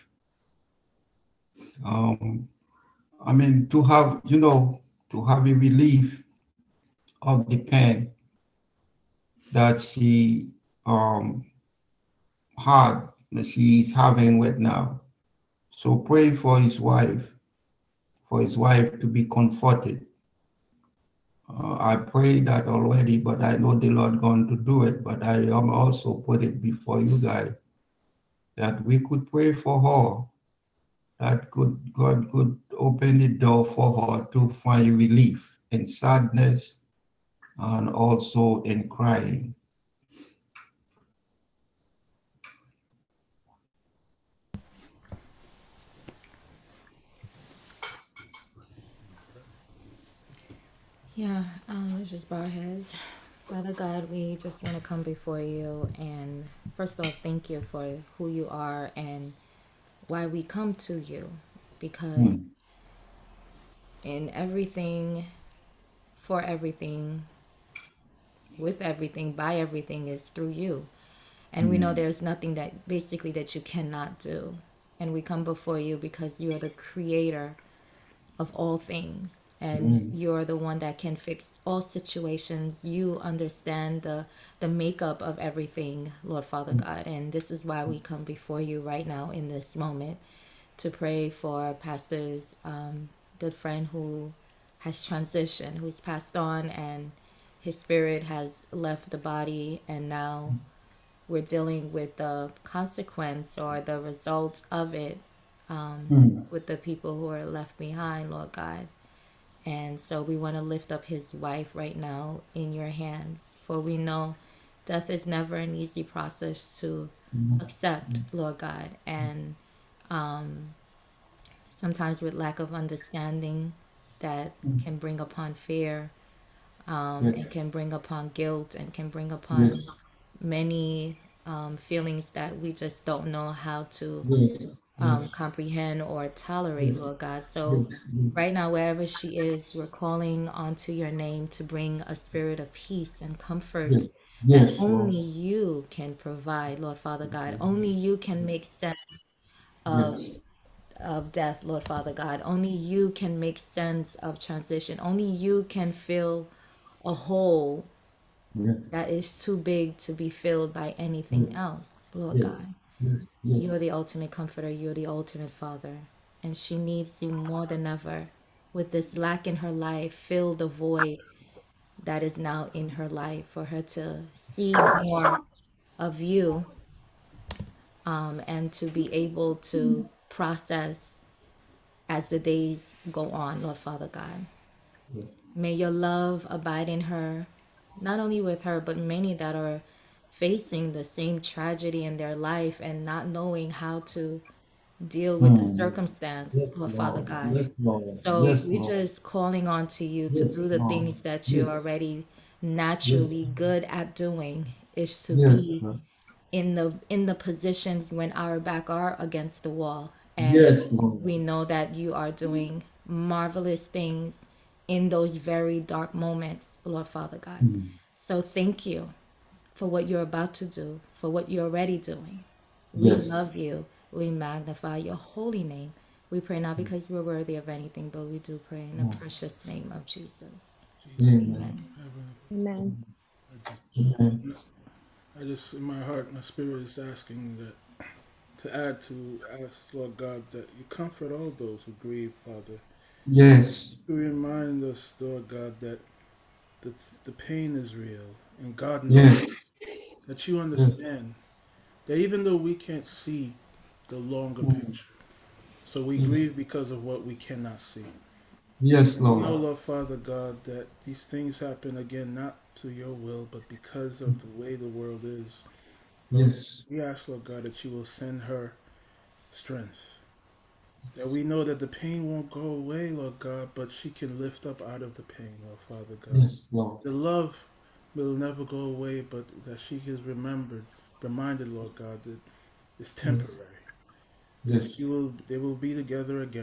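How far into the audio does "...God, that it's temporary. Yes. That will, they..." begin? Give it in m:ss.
4:41.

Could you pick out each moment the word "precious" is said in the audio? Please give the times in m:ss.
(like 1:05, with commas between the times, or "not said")
3:49.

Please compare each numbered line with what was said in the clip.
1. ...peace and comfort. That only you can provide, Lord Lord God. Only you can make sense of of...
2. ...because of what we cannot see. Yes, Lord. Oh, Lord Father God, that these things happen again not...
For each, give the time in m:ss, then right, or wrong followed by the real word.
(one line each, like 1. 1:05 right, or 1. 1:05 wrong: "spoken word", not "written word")
1. 2:22 wrong: "Father", not "Lord"
2. 4:16 right.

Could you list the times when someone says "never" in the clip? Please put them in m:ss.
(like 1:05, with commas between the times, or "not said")
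1:55, 4:38.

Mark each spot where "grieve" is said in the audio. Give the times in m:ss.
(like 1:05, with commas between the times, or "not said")
4:02, 4:16.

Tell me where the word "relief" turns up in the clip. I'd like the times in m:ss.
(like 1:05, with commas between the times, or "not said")
0:05, 0:34.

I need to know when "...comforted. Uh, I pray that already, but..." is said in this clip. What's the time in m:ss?
0:19.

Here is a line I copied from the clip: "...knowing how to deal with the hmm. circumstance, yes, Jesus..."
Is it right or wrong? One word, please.
wrong.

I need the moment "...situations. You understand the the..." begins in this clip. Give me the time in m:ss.
1:21.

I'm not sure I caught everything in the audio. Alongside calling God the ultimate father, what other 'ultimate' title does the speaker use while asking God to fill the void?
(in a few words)
Ultimate comforter.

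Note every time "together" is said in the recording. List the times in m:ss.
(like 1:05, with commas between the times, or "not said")
4:45.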